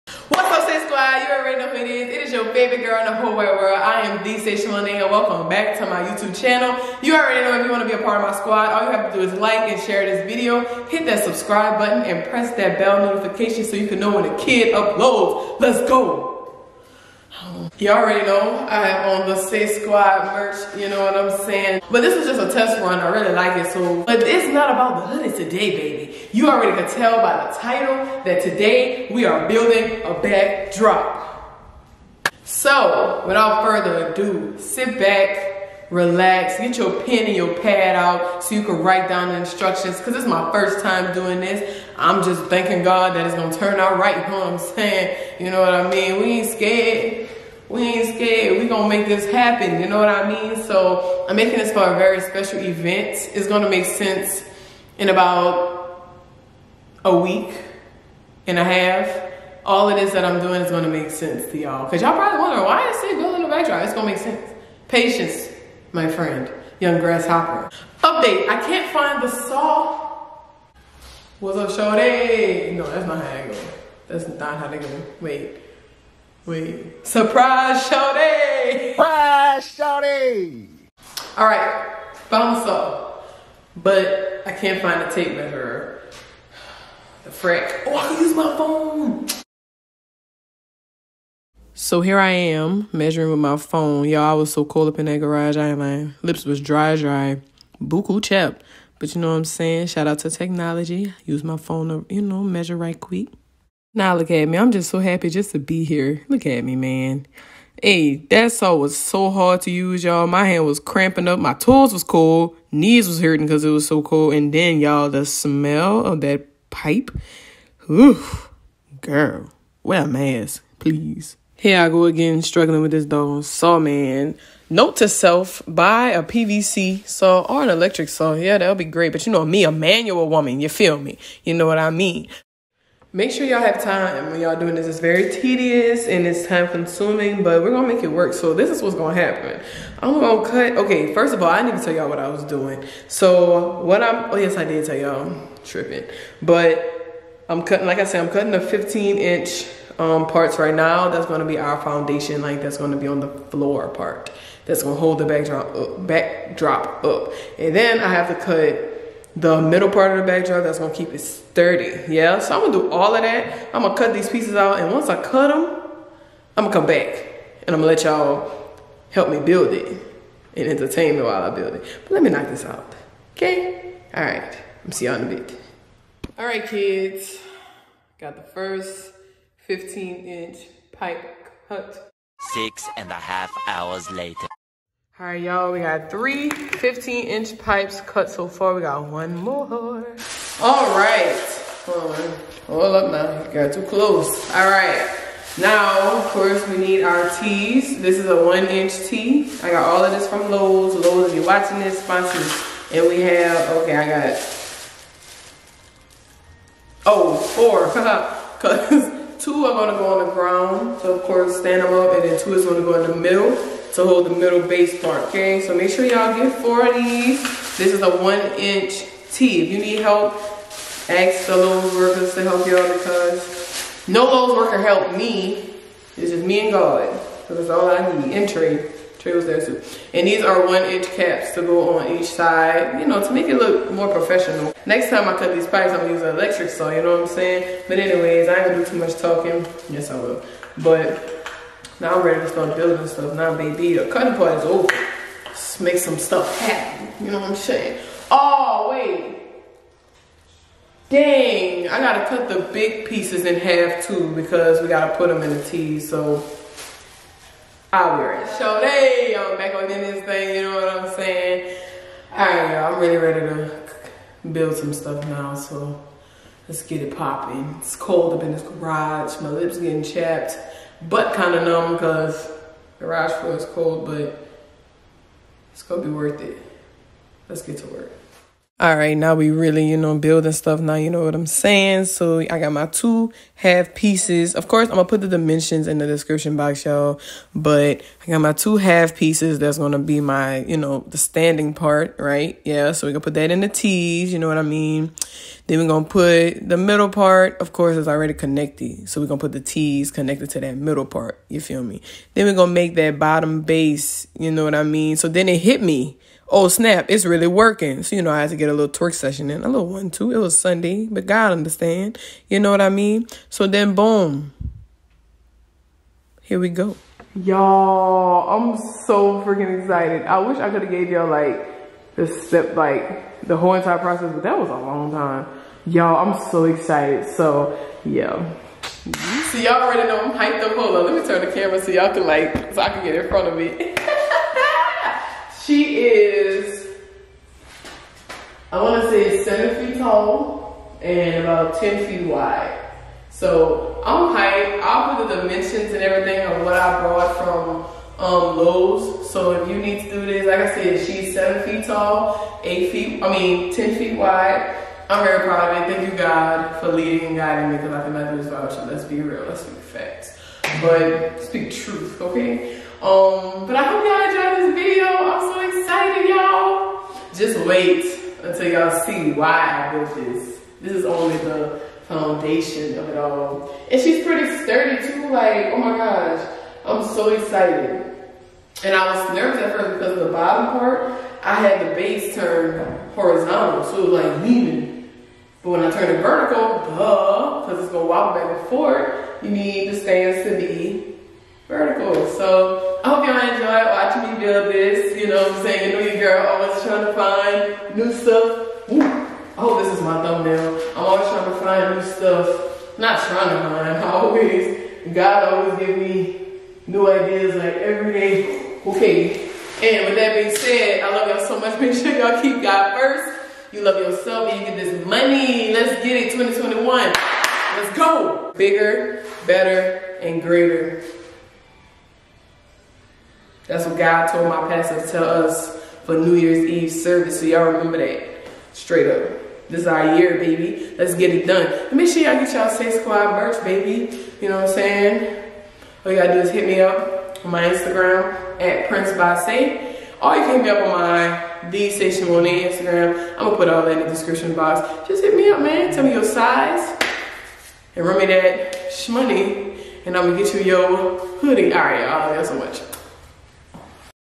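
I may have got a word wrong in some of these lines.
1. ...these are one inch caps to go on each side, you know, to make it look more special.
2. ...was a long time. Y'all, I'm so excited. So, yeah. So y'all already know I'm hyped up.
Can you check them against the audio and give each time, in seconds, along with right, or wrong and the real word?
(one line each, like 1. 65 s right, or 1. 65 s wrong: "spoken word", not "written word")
1. 230 s wrong: "professional", not "special"
2. 324 s right.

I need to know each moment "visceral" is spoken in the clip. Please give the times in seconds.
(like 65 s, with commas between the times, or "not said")
not said.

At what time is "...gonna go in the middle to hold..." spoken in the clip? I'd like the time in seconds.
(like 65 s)
212 s.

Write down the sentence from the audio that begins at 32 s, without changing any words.
So, without further ado, sit back, relax, get your pen and your pad out so you can write down the instructions.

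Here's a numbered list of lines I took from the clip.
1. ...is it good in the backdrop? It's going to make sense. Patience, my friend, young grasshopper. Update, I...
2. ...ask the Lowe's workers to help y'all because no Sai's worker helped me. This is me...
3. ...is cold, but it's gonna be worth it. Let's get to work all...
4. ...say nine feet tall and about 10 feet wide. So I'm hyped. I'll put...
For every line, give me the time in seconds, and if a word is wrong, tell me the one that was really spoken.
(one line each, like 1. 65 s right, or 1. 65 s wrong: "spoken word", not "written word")
1. 62 s right
2. 221 s wrong: "Lowe", not "Sai"
3. 273 s right
4. 339 s wrong: "seven", not "nine".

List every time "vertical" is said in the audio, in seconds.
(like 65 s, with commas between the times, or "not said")
386 s, 391 s.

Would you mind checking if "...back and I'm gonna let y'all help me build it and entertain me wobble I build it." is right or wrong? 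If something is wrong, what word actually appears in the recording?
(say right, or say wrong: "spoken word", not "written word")
wrong: "while", not "wobble".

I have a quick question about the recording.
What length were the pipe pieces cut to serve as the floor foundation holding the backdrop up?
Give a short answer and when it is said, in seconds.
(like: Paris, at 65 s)
15 inch, at 148 s.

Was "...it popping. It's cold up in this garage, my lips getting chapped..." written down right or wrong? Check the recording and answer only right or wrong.
right.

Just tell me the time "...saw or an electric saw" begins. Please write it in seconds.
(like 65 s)
127 s.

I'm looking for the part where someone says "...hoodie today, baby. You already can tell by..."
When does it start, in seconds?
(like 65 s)
25 s.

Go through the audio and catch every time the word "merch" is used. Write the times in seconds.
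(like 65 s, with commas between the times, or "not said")
20 s, 433 s.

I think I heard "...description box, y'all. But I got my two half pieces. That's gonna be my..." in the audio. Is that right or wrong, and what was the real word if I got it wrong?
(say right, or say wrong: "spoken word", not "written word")
right.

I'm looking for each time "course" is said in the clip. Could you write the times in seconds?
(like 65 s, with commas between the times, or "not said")
196 s, 211 s, 284 s, 297 s.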